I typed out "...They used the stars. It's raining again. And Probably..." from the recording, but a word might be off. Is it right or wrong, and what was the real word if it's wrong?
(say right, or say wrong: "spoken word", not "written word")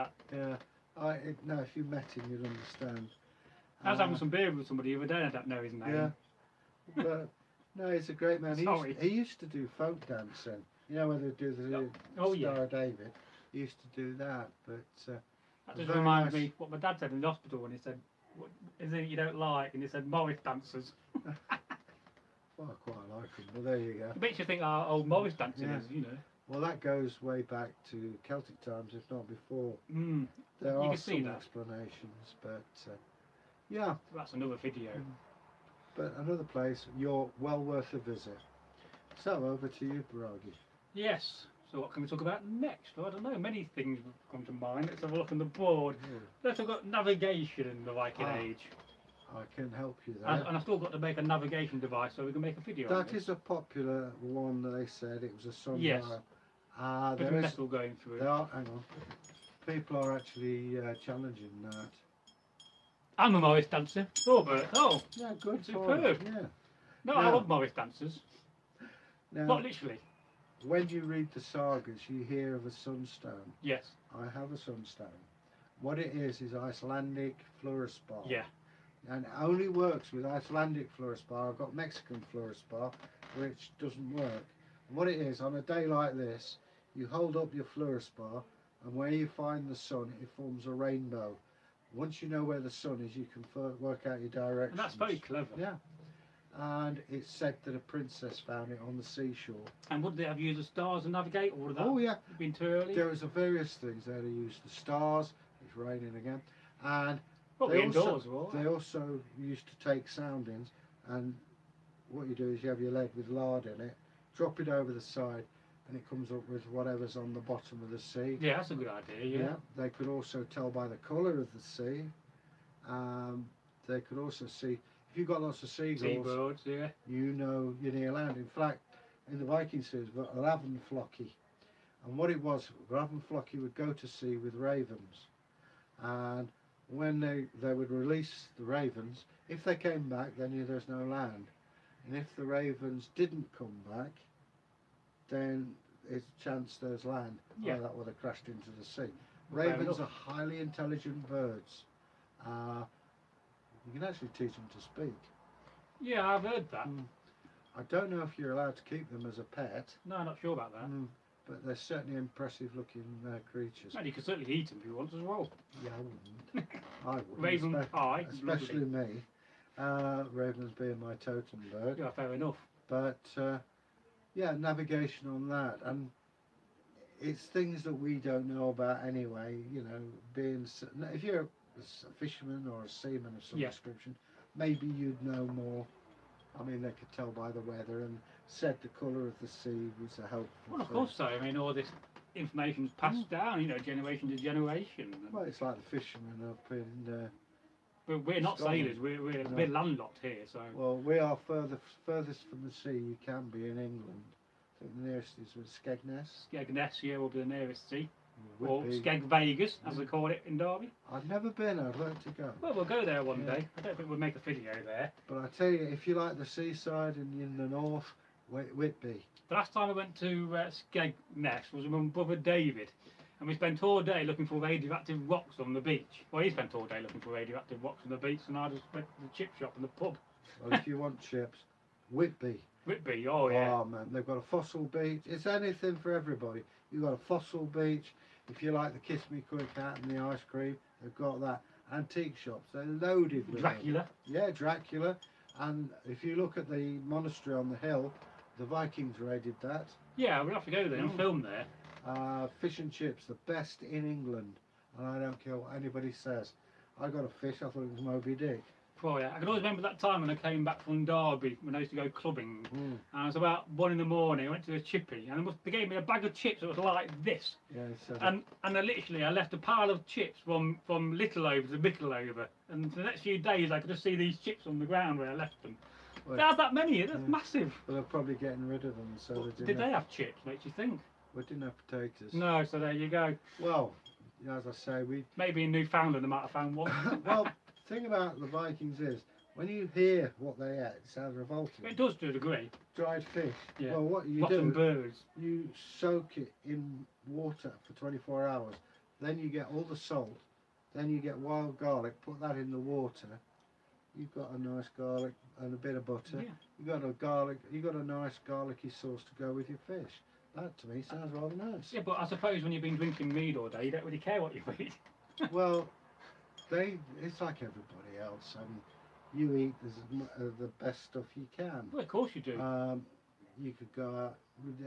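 right.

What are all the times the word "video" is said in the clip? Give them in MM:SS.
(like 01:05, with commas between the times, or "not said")
00:34, 00:52, 03:34.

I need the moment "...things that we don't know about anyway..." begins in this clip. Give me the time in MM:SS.
02:57.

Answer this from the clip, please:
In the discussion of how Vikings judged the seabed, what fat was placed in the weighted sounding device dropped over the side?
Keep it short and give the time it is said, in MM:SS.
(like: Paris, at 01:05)
lard, at 01:53.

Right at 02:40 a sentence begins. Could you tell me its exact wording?
Mm but they're certainly impressive looking uh, creatures.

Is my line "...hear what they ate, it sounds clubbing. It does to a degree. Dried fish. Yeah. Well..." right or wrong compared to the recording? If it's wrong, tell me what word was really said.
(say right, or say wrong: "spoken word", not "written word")
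wrong: "revolting", not "clubbing".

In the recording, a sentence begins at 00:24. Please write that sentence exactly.
It makes you think our old Morris dancing yeah.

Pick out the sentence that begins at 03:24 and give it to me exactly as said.
I think the nearest is with Skegness.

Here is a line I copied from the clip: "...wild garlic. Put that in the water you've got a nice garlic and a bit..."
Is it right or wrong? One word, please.
right.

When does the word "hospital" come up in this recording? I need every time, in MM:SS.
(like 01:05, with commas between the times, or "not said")
00:17.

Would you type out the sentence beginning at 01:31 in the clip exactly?
Once you know where the sun is, you can work out your direction.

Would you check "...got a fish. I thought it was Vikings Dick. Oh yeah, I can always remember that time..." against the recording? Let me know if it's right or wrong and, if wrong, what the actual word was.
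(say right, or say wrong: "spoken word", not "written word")
wrong: "Moby", not "Vikings".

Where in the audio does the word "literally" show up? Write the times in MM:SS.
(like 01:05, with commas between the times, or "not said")
01:09, 04:28.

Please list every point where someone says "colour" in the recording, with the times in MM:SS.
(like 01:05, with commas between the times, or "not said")
02:00, 03:08.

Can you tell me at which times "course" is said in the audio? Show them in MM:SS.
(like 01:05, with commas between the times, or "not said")
03:10, 05:22.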